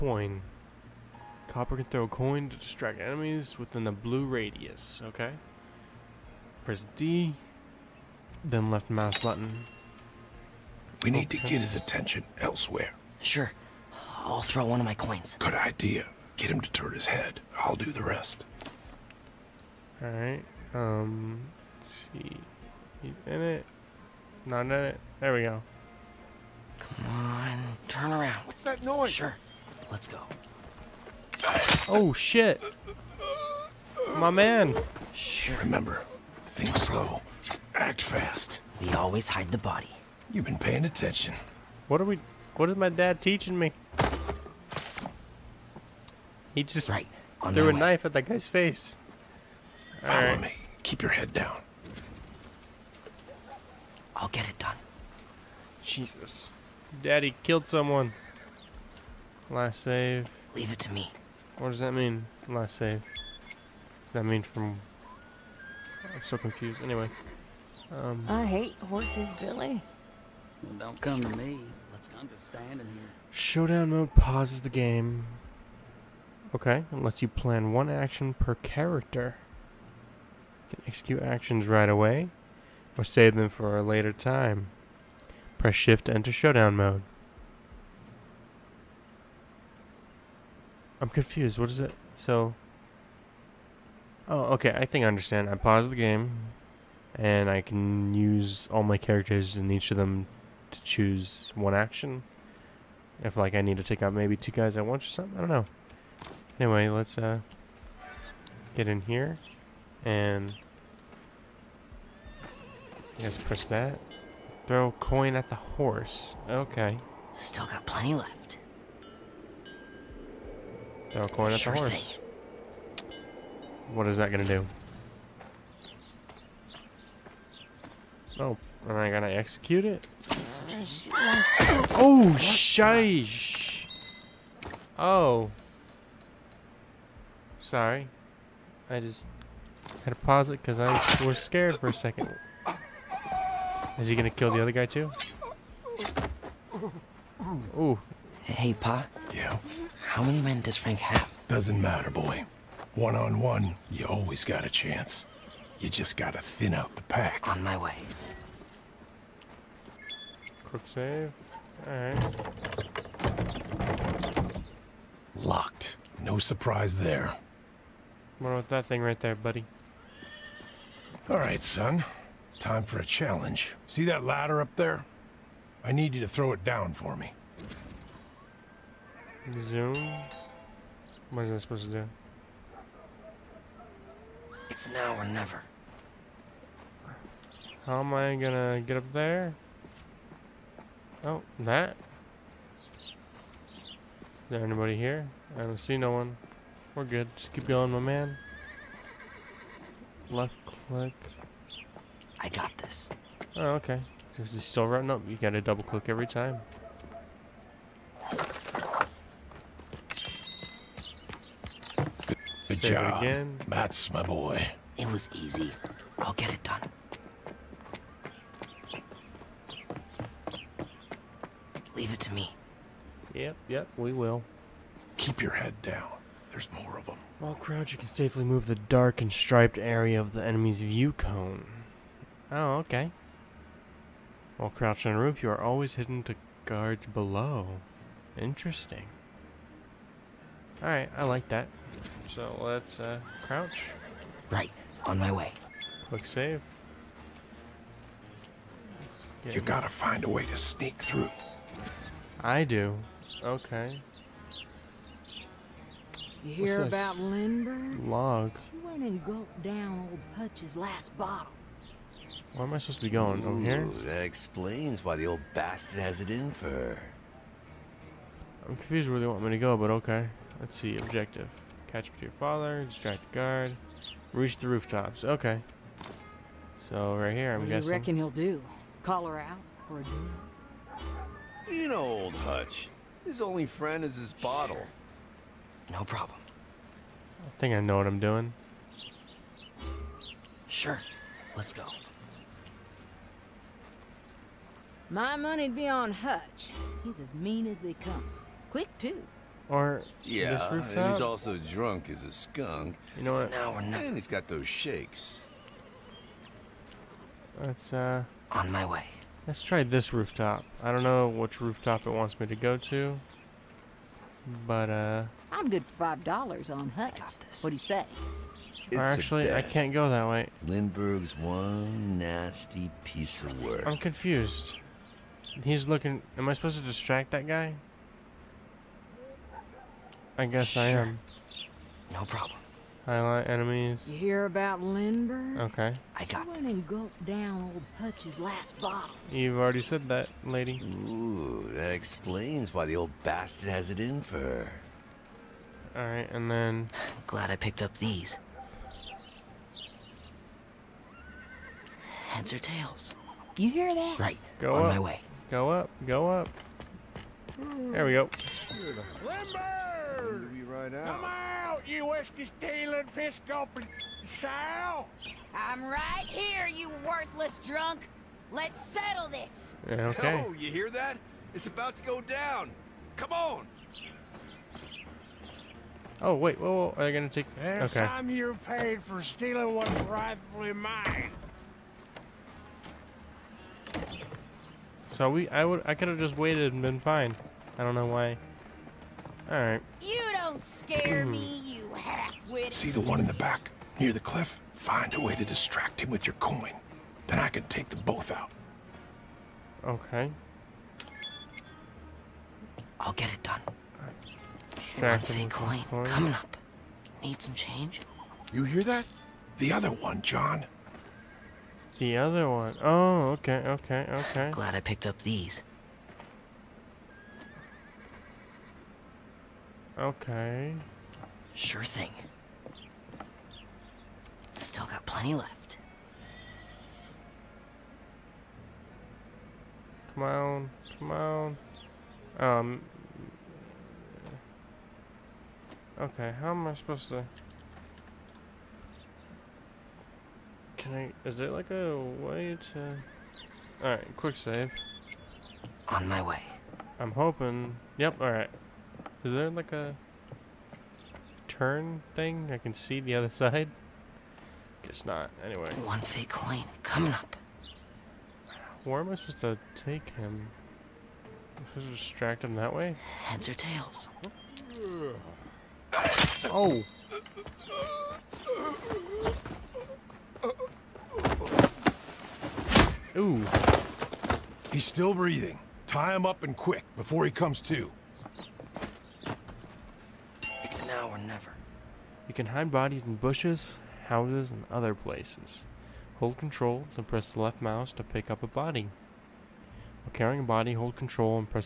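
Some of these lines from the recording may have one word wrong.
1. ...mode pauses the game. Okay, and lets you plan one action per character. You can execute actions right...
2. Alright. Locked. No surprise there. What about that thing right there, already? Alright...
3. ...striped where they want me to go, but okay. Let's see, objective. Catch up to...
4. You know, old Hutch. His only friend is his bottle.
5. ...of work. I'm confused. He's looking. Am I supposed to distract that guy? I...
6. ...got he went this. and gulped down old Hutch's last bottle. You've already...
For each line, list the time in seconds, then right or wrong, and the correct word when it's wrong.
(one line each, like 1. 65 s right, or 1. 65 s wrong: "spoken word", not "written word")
1. 73 s right
2. 161 s wrong: "buddy", not "already"
3. 268 s wrong: "confused", not "striped"
4. 281 s right
5. 323 s right
6. 336 s right.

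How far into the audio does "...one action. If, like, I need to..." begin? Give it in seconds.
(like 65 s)
101 s.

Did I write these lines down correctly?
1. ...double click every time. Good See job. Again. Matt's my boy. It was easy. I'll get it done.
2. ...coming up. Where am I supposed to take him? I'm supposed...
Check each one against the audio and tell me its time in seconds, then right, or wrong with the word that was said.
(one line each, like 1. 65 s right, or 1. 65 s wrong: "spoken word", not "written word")
1. 205 s wrong: "Save", not "See"
2. 456 s right.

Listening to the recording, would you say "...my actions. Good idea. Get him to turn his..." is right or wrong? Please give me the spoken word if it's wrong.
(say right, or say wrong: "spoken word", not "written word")
wrong: "coins", not "actions".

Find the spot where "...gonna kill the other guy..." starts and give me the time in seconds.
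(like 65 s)
144 s.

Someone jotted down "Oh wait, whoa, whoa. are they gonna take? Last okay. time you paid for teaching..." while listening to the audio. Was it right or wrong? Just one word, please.
wrong.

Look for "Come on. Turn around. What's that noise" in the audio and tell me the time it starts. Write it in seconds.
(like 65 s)
26 s.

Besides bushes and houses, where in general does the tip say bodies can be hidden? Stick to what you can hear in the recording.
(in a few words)
Other places.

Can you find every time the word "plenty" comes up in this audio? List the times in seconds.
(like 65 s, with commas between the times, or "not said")
117 s, 425 s.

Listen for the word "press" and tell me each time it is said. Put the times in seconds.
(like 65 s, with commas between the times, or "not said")
6 s, 85 s, 113 s, 487 s.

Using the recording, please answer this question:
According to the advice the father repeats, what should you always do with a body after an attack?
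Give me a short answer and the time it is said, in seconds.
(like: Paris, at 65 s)
Hide the body, at 38 s.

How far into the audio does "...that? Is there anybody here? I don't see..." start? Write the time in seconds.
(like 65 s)
191 s.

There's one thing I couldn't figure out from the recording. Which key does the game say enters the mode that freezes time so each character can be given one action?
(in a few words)
Shift.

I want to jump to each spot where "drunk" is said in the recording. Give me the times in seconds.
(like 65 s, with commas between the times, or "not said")
301 s, 367 s.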